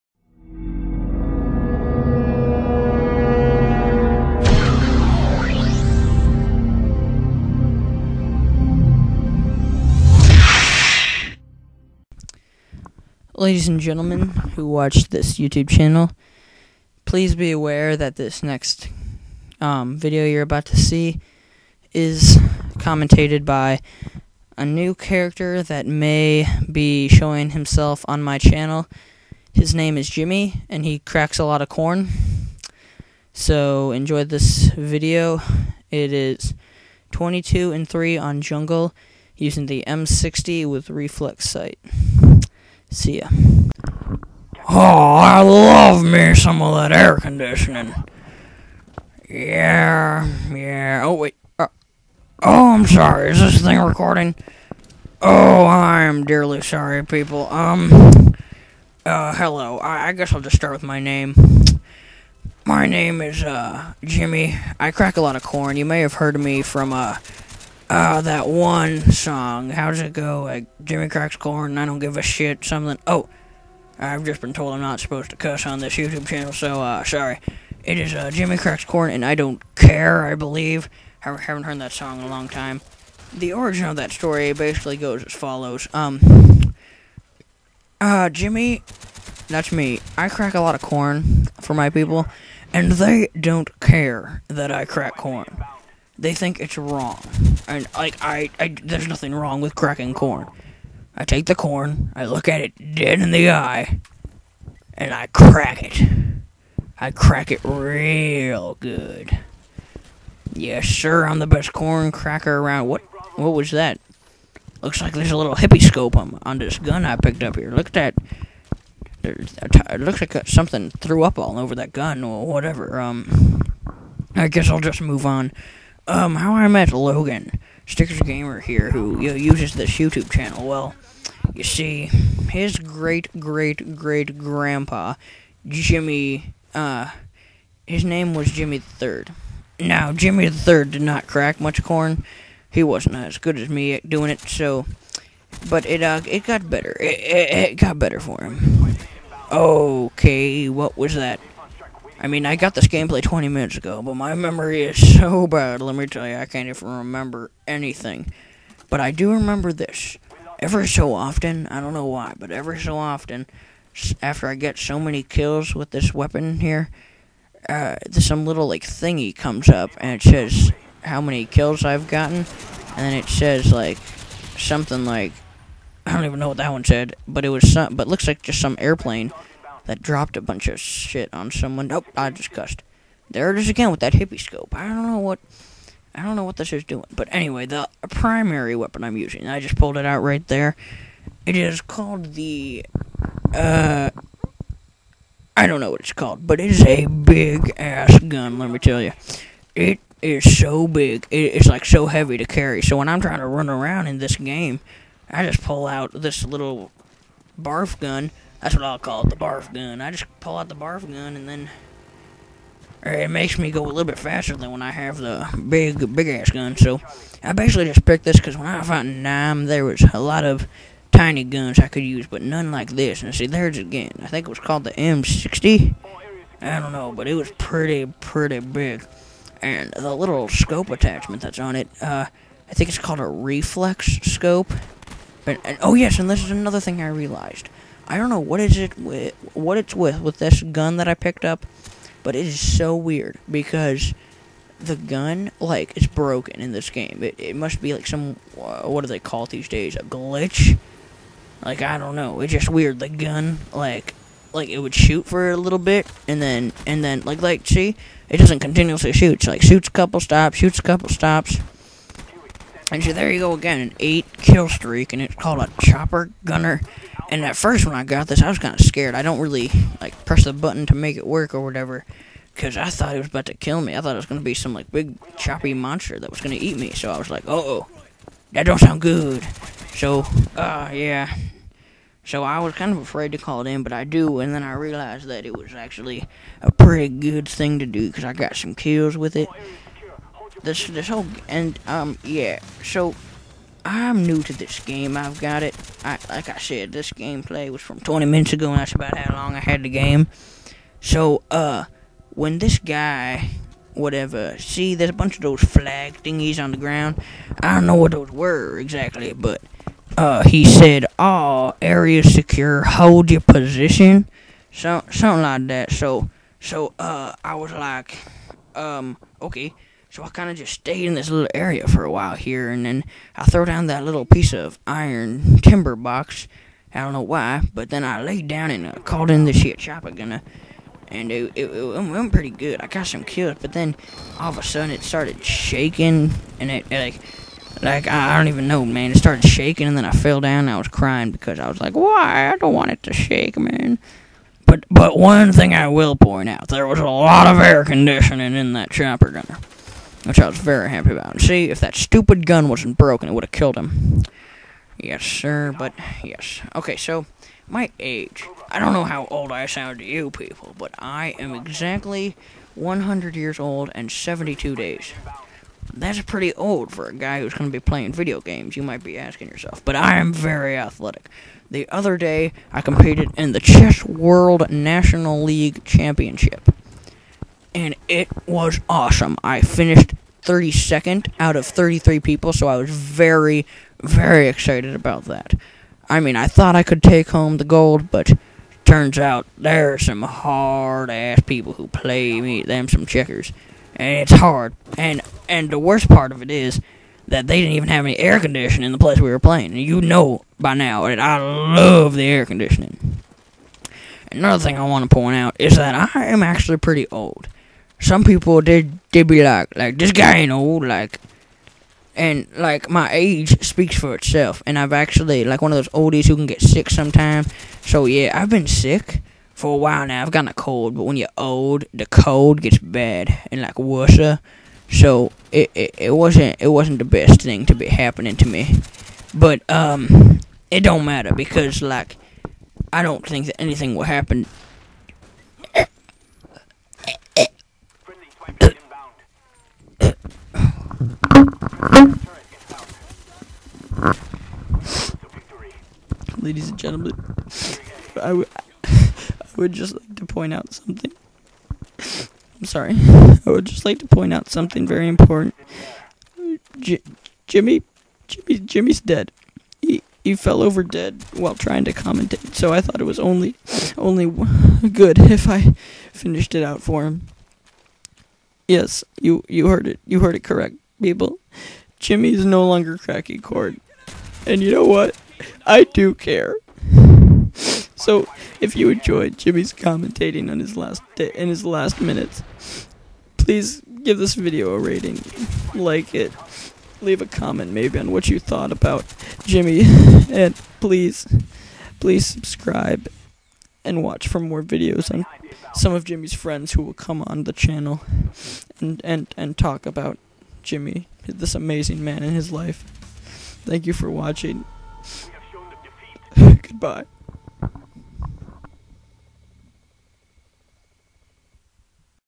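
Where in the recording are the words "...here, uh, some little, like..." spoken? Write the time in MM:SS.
02:46.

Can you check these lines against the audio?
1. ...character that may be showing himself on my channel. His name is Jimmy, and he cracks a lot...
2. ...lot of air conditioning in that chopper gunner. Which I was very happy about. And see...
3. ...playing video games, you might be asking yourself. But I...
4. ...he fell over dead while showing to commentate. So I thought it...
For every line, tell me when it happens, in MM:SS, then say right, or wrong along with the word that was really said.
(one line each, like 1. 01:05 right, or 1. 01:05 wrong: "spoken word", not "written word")
1. 00:24 right
2. 05:47 right
3. 06:07 right
4. 07:40 wrong: "trying", not "showing".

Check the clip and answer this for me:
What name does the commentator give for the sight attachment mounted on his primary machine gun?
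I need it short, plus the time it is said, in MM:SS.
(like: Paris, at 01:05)
Reflex scope, at 03:53.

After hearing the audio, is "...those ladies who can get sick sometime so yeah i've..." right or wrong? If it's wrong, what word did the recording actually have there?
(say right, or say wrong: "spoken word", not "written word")
wrong: "oldies", not "ladies".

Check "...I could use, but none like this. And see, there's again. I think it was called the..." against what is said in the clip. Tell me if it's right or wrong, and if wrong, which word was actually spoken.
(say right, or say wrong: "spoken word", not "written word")
right.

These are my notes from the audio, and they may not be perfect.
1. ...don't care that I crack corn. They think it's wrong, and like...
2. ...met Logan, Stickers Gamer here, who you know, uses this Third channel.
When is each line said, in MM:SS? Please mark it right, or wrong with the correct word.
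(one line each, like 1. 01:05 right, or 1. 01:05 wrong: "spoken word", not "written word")
1. 01:33 right
2. 02:06 wrong: "YouTube", not "Third".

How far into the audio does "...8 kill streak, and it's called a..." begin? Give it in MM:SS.
04:24.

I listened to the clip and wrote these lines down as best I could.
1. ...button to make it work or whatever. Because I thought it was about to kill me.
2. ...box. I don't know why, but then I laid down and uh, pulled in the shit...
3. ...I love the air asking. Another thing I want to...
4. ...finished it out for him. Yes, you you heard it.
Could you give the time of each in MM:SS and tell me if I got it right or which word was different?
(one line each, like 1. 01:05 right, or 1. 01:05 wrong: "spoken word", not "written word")
1. 04:30 right
2. 05:25 wrong: "called", not "pulled"
3. 06:41 wrong: "conditioning", not "asking"
4. 07:46 right.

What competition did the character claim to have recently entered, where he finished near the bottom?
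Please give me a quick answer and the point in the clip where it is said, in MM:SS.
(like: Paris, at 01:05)
Chess World National League Championship, at 06:13.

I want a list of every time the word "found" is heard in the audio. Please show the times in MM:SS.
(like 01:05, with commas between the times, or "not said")
03:38.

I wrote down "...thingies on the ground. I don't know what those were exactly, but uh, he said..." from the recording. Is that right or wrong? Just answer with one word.
right.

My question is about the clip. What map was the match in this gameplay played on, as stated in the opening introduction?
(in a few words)
Jungle.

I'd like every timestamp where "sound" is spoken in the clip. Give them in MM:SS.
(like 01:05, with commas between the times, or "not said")
04:38, 05:59.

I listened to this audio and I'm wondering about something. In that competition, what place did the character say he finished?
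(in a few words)
32nd.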